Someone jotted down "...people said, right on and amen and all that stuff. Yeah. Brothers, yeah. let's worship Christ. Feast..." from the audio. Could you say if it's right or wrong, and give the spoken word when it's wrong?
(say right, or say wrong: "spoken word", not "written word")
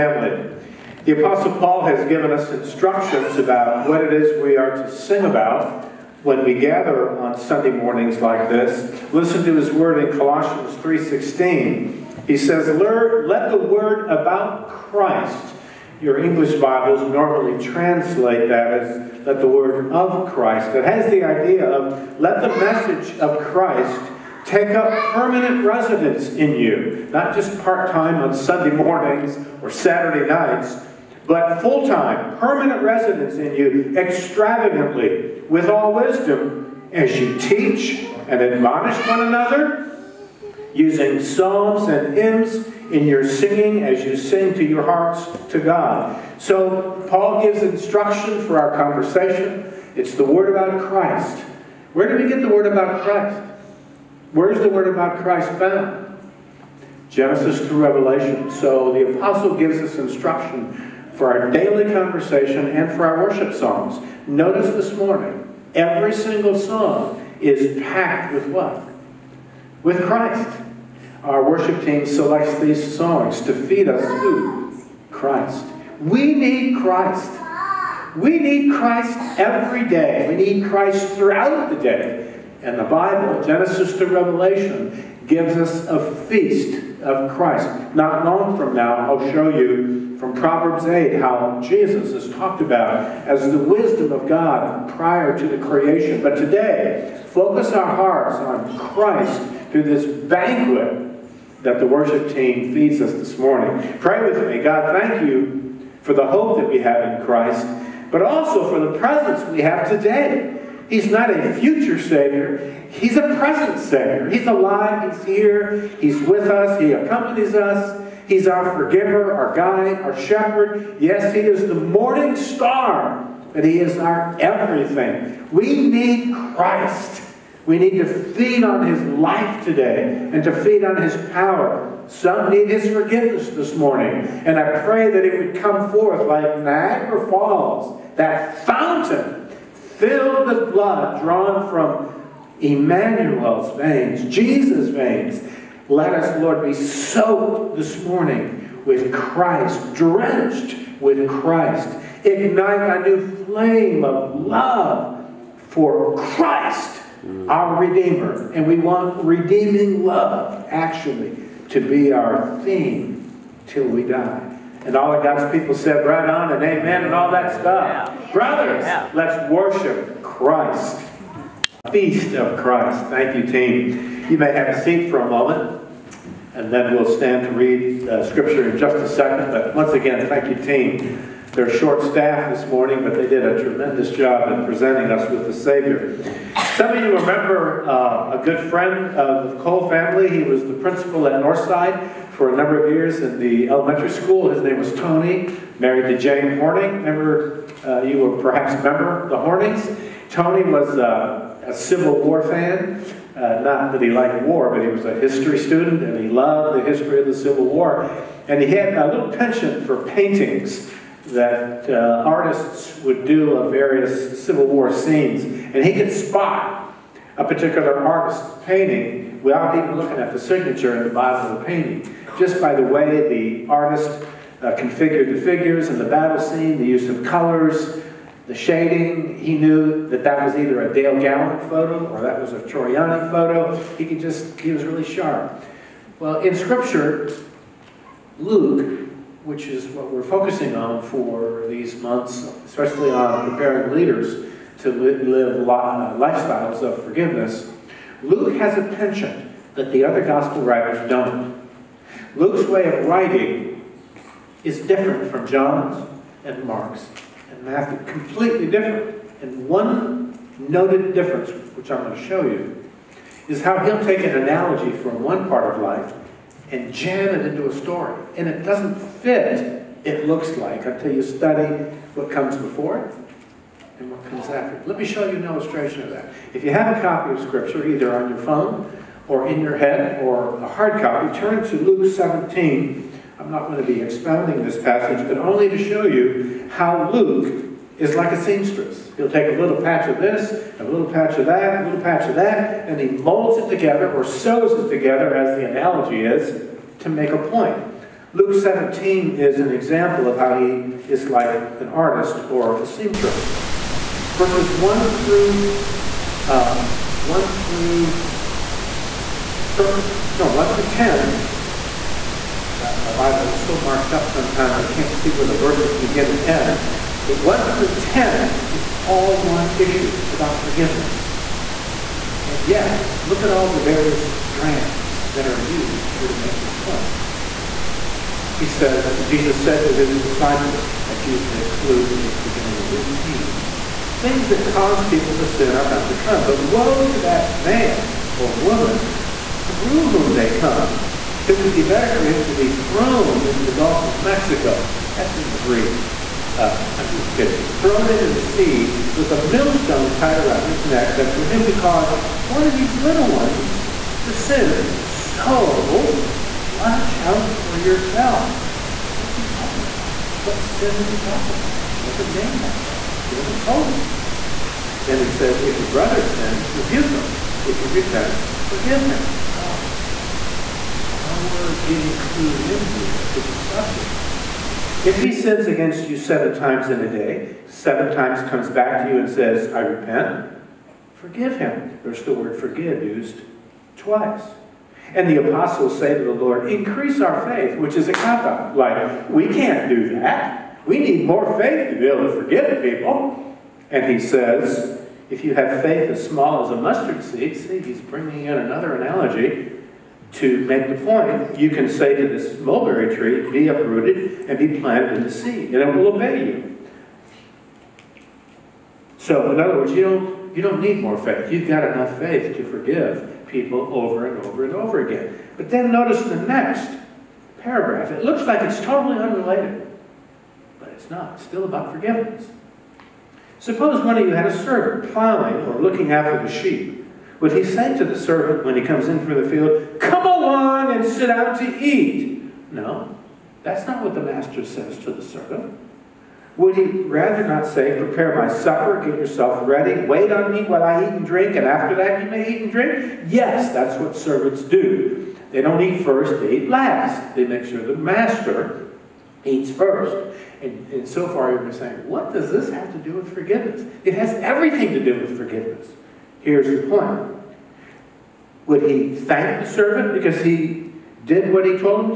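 right.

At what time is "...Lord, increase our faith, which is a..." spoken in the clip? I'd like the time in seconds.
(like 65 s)
386 s.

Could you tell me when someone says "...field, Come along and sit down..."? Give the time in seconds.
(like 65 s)
429 s.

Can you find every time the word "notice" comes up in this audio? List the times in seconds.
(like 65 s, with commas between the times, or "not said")
64 s, 415 s.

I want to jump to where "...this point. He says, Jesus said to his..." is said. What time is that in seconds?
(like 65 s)
326 s.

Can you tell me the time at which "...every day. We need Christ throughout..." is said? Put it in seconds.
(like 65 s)
79 s.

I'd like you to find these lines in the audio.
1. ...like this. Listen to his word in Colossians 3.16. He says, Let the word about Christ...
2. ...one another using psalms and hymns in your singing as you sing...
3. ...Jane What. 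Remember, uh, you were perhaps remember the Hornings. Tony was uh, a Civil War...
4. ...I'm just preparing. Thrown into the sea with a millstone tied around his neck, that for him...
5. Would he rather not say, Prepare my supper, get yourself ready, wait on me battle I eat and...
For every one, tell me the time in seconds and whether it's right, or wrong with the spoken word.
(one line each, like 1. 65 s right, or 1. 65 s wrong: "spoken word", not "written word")
1. 8 s right
2. 39 s right
3. 196 s wrong: "Horning", not "What"
4. 346 s wrong: "kidding", not "preparing"
5. 436 s wrong: "while", not "battle".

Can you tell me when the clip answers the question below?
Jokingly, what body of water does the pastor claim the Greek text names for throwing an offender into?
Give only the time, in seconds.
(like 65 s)
343 s.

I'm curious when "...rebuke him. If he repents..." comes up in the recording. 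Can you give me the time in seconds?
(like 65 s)
366 s.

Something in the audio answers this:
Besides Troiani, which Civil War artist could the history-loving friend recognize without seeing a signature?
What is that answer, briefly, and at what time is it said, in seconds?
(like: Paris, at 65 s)
Dale Gallon, at 230 s.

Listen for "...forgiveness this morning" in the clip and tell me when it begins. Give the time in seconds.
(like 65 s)
132 s.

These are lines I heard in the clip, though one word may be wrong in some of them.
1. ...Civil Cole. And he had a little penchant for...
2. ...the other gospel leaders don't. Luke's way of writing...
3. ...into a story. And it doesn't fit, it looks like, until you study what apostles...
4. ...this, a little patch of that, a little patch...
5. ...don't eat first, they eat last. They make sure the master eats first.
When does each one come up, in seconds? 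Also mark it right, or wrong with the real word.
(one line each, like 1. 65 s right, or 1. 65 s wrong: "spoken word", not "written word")
1. 207 s wrong: "War", not "Cole"
2. 249 s wrong: "writers", not "leaders"
3. 267 s wrong: "comes", not "apostles"
4. 290 s right
5. 445 s right.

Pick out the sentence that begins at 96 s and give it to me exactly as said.
But today, focus our hearts on Christ through this banquet that the worship team feeds us this morning.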